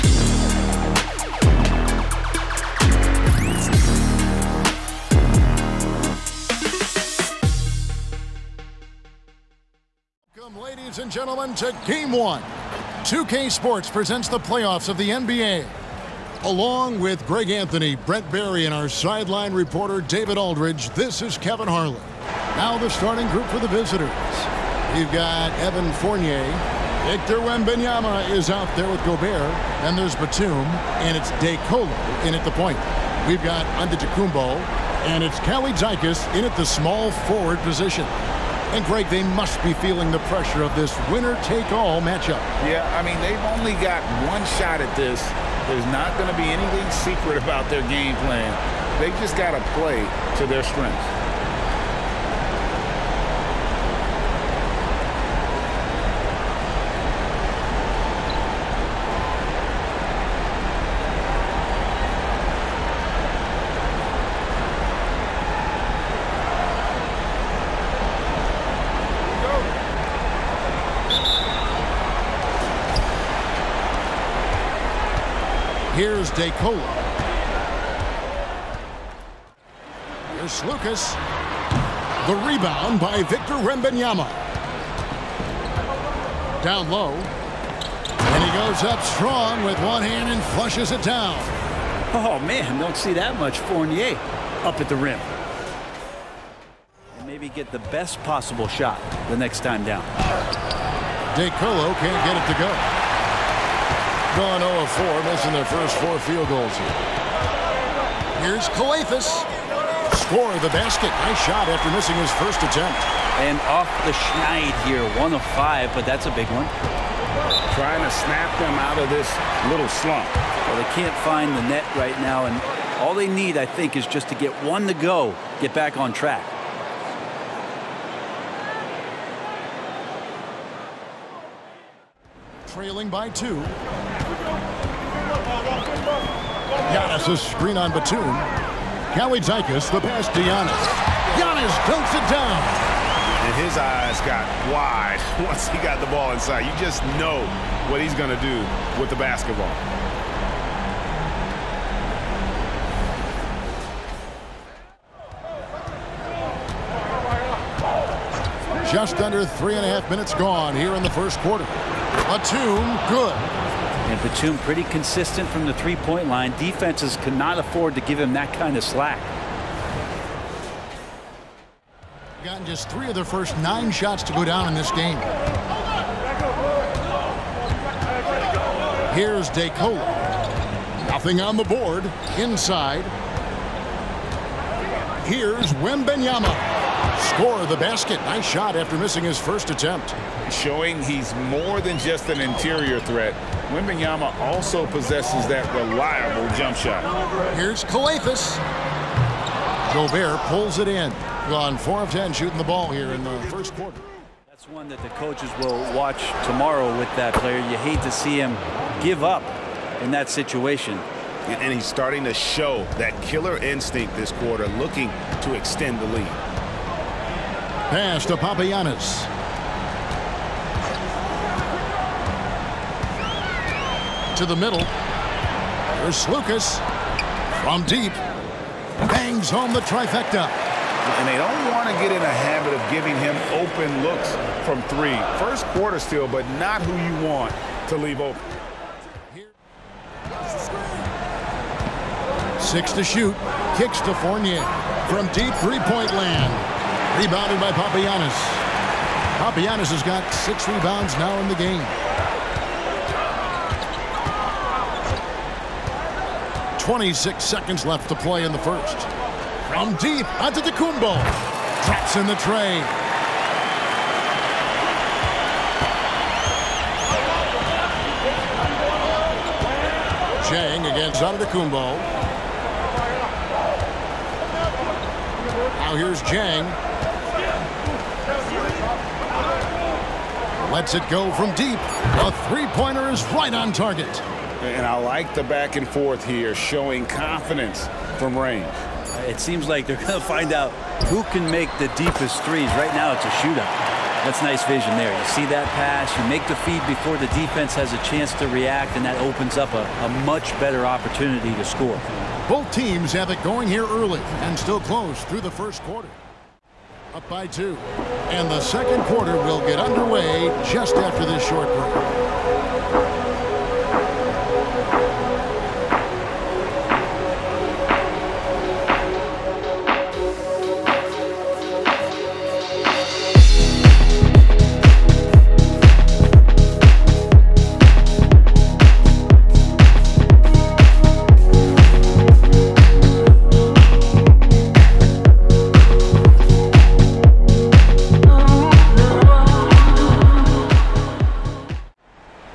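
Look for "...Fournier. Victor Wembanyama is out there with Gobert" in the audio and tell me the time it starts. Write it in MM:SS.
00:25.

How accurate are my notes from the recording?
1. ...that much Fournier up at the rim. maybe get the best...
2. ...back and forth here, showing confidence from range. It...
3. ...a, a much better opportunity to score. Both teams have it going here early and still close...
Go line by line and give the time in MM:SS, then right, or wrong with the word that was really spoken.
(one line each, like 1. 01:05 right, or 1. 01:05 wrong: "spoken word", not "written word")
1. 01:33 right
2. 04:45 right
3. 04:59 right.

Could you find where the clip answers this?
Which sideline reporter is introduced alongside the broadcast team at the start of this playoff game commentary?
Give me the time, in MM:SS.
00:20.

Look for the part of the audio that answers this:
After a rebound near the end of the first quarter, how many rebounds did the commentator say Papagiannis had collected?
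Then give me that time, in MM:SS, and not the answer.
04:10.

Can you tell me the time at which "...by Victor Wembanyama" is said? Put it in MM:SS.
01:22.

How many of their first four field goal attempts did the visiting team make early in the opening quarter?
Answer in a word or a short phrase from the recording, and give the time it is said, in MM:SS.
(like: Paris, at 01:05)
0, at 01:44.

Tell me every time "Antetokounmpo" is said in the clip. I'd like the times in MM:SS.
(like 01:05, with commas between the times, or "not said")
00:33, 04:31.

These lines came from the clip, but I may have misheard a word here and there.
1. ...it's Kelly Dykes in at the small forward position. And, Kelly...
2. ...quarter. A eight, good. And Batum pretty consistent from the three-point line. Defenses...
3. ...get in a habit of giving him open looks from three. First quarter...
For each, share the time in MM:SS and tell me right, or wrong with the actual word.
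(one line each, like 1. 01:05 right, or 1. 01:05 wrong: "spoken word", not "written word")
1. 00:35 wrong: "Greg", not "Kelly"
2. 02:41 wrong: "two", not "eight"
3. 03:52 right.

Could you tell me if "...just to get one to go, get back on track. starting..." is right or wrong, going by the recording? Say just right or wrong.
wrong.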